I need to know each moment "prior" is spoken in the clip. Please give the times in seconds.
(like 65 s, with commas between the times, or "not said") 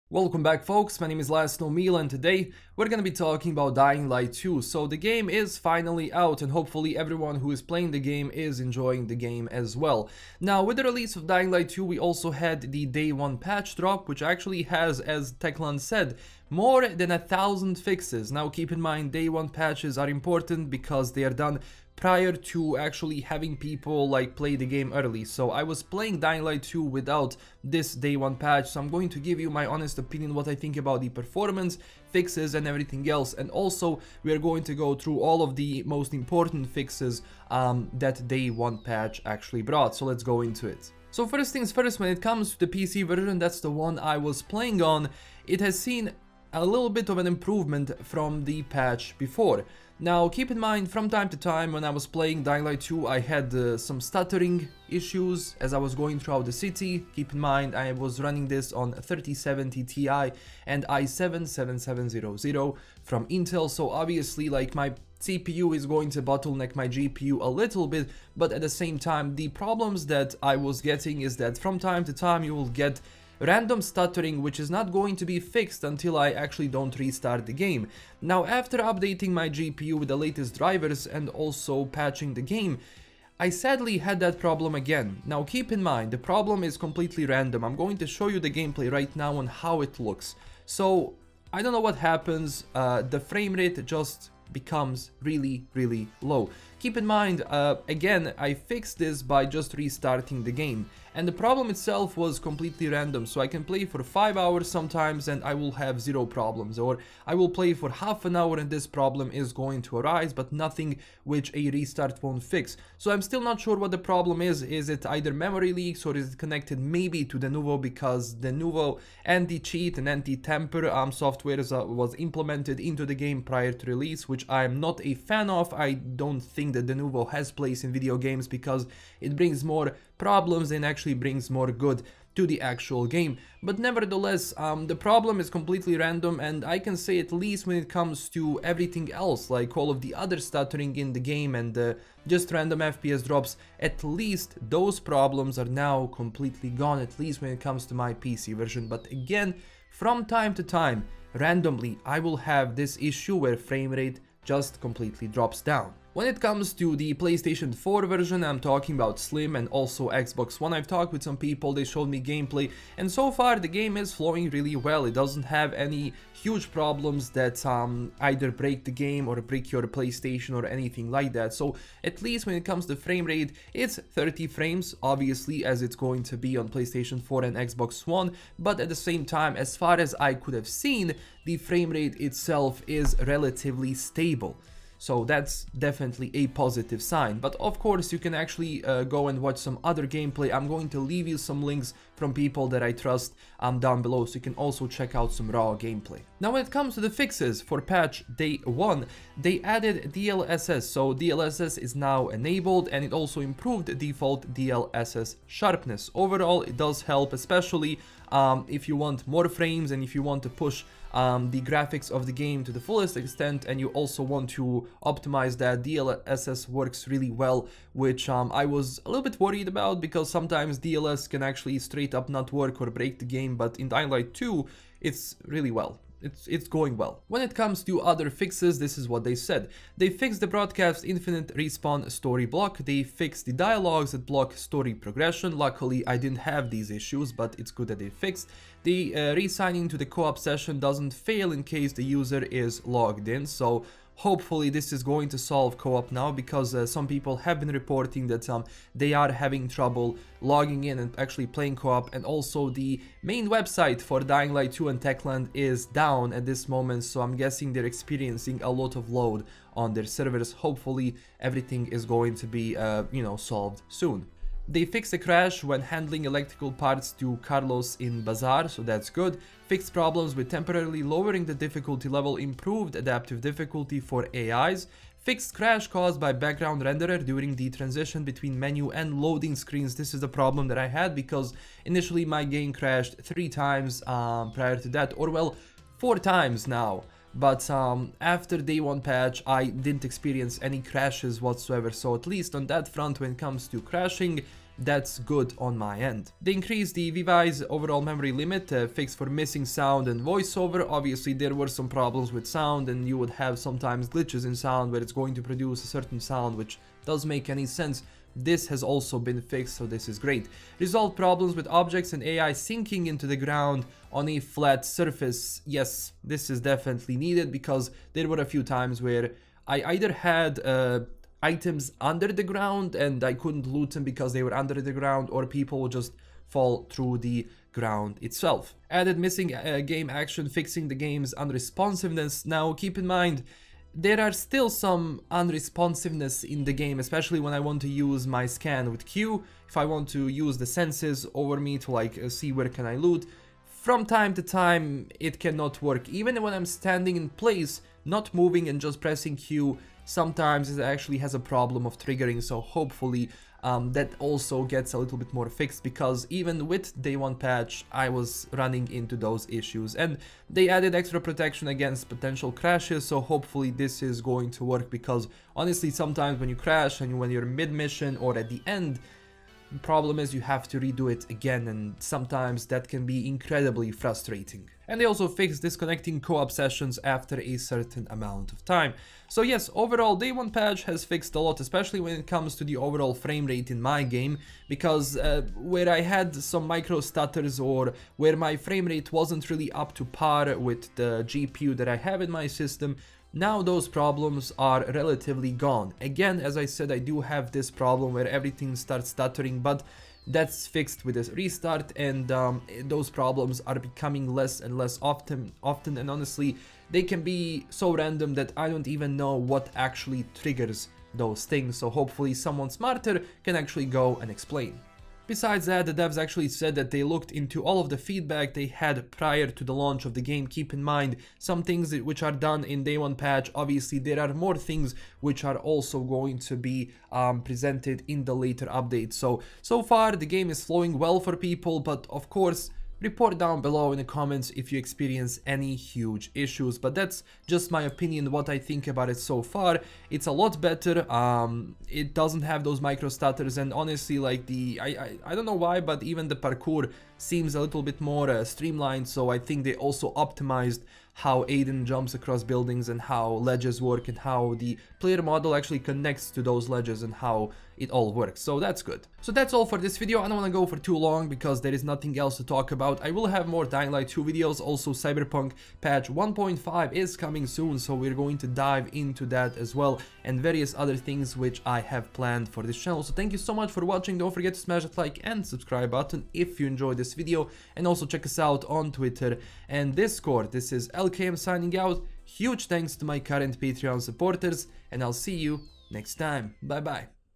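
22 s, 123 s, 284 s, 419 s.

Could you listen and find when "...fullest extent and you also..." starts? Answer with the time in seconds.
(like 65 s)
212 s.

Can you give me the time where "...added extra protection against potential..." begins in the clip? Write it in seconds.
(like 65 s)
360 s.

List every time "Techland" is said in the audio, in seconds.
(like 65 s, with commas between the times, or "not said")
15 s, 255 s.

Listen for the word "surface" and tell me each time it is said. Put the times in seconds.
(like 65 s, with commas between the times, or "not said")
314 s.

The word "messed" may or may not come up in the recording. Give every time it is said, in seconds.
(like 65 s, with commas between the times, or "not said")
not said.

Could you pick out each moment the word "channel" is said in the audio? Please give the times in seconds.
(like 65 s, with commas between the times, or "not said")
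472 s.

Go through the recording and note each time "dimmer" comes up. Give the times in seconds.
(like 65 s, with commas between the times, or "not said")
not said.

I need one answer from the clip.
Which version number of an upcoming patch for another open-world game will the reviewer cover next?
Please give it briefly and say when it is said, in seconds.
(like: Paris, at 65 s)
1.5, at 464 s.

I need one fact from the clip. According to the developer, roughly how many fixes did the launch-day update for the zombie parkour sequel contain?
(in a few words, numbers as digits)
more than 1000.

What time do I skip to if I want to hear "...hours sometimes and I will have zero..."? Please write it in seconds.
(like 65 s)
104 s.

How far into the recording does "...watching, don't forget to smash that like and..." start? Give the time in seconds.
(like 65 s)
473 s.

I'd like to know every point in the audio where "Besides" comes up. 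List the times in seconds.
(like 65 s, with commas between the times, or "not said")
415 s.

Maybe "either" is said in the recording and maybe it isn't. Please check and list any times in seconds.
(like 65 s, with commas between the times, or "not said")
115 s, 168 s, 319 s.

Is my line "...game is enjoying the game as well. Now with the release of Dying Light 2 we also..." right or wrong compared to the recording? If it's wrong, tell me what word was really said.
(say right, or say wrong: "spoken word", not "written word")
right.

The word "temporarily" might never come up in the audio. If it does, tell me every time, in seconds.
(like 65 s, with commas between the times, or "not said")
270 s.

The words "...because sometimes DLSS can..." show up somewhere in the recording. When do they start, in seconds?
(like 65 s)
219 s.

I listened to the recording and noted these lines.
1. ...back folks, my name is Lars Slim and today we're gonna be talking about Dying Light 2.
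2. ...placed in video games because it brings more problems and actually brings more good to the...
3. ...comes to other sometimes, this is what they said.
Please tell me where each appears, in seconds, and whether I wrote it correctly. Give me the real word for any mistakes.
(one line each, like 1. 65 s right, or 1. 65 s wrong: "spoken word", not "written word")
1. 0 s wrong: "Miel", not "Slim"
2. 127 s right
3. 227 s wrong: "fixes", not "sometimes".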